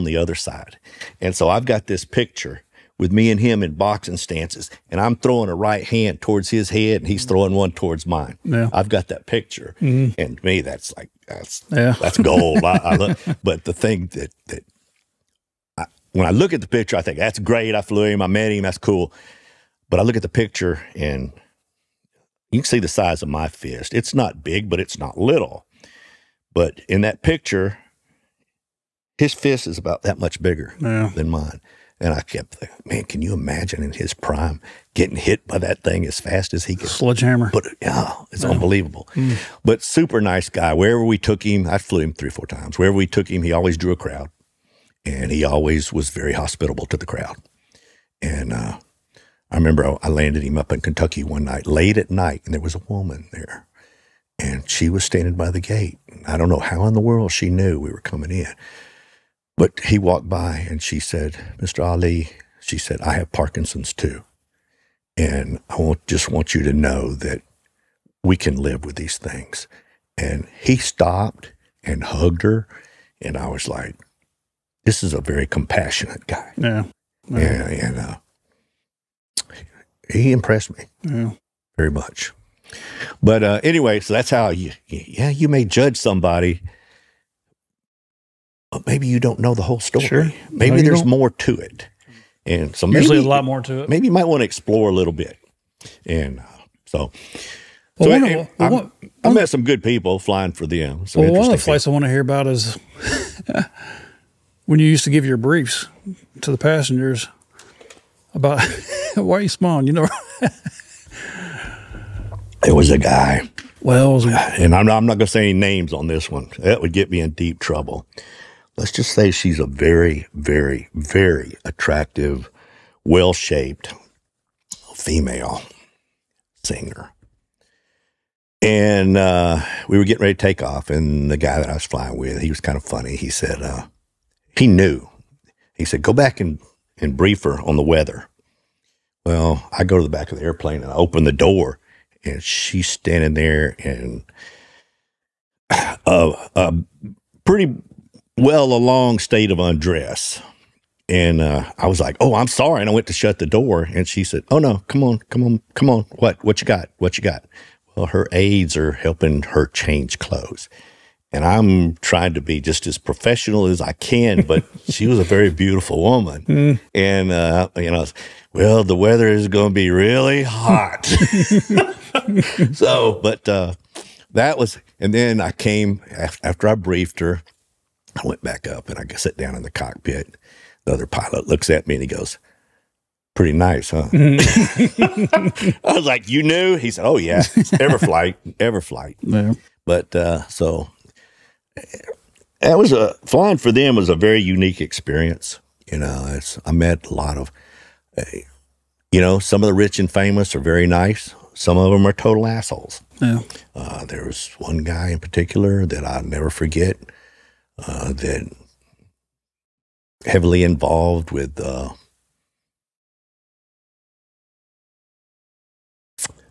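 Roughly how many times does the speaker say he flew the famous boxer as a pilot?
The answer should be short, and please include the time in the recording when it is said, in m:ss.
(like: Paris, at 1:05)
3 or 4 times, at 0:42.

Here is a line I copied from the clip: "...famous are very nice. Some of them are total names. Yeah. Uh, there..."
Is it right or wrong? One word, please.
wrong.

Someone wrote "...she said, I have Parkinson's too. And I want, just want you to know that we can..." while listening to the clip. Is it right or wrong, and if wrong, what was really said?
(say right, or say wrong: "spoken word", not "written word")
right.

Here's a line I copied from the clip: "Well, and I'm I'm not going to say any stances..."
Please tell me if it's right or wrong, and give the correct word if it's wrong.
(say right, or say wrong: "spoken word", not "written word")
wrong: "names", not "stances".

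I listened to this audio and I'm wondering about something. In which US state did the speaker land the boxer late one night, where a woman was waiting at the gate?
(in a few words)
Kentucky.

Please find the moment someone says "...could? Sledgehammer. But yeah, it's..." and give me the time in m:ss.
0:36.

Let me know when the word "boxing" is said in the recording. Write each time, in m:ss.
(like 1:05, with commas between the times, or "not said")
0:03.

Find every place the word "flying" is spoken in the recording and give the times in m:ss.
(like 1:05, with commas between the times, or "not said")
1:40, 2:11, 3:13.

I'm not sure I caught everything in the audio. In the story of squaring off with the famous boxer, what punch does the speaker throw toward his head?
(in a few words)
A right hand.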